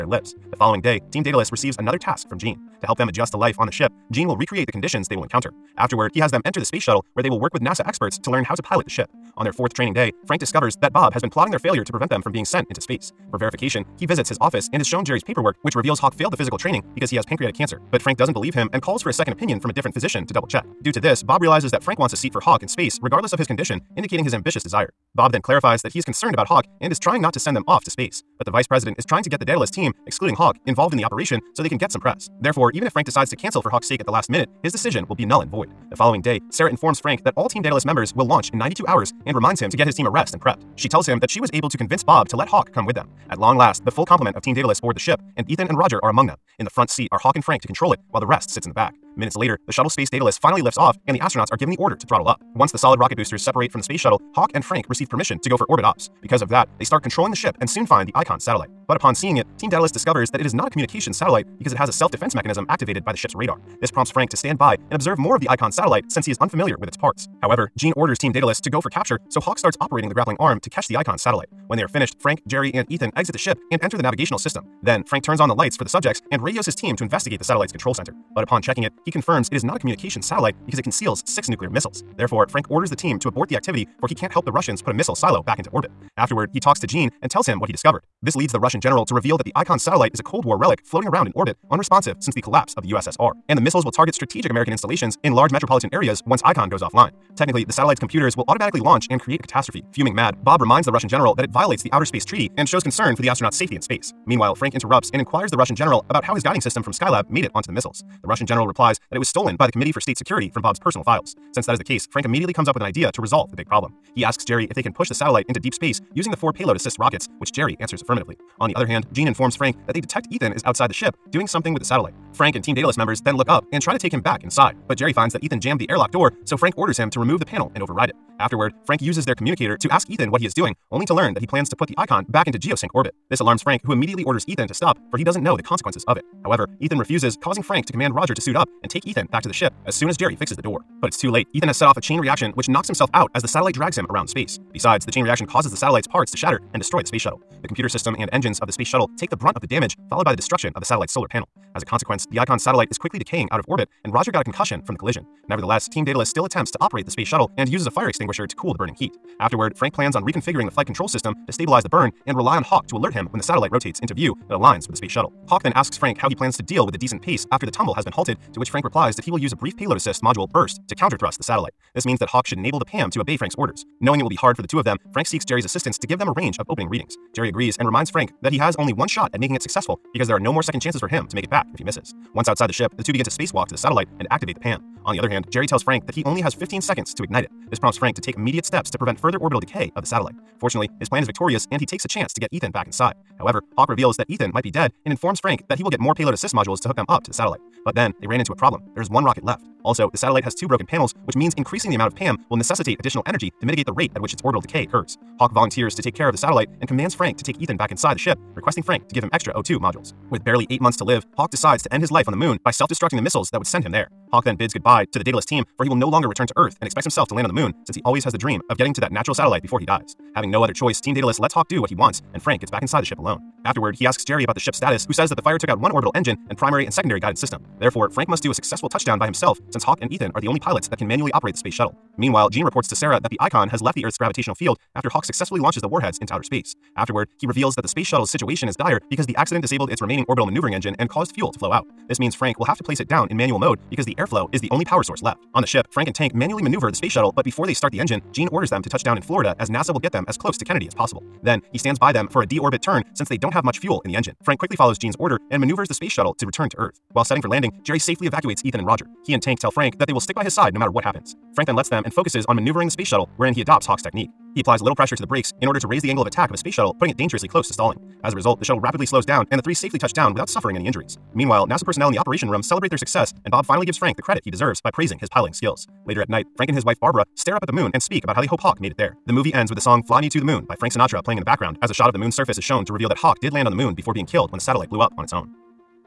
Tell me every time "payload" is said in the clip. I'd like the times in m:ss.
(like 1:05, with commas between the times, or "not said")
1:56, 2:49, 3:16.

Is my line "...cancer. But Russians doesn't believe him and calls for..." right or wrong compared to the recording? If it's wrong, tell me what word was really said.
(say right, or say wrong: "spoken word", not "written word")
wrong: "Frank", not "Russians".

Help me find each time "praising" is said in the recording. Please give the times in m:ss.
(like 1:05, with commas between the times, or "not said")
4:34.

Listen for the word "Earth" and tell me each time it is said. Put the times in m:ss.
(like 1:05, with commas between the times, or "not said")
3:36, 3:54, 4:16.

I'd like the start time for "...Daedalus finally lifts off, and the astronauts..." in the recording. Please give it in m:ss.
0:50.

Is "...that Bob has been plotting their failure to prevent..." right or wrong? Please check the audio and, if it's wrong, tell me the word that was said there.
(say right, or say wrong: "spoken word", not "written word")
right.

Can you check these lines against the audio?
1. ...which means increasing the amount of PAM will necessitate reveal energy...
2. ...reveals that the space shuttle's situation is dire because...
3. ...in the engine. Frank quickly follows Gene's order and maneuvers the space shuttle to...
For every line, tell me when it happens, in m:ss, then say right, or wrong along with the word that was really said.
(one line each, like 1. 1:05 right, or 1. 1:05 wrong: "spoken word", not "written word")
1. 3:21 wrong: "additional", not "reveal"
2. 3:57 right
3. 4:14 right.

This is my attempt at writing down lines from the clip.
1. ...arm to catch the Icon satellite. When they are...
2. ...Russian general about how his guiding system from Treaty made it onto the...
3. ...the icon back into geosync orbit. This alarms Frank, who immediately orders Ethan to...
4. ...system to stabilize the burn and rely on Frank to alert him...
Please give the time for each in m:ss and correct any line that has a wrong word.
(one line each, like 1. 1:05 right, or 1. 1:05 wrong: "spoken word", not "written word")
1. 1:10 right
2. 1:45 wrong: "Skylab", not "Treaty"
3. 2:11 right
4. 2:41 wrong: "Hawk", not "Frank".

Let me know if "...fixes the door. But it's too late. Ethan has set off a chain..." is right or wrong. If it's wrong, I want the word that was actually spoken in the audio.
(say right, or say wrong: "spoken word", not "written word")
right.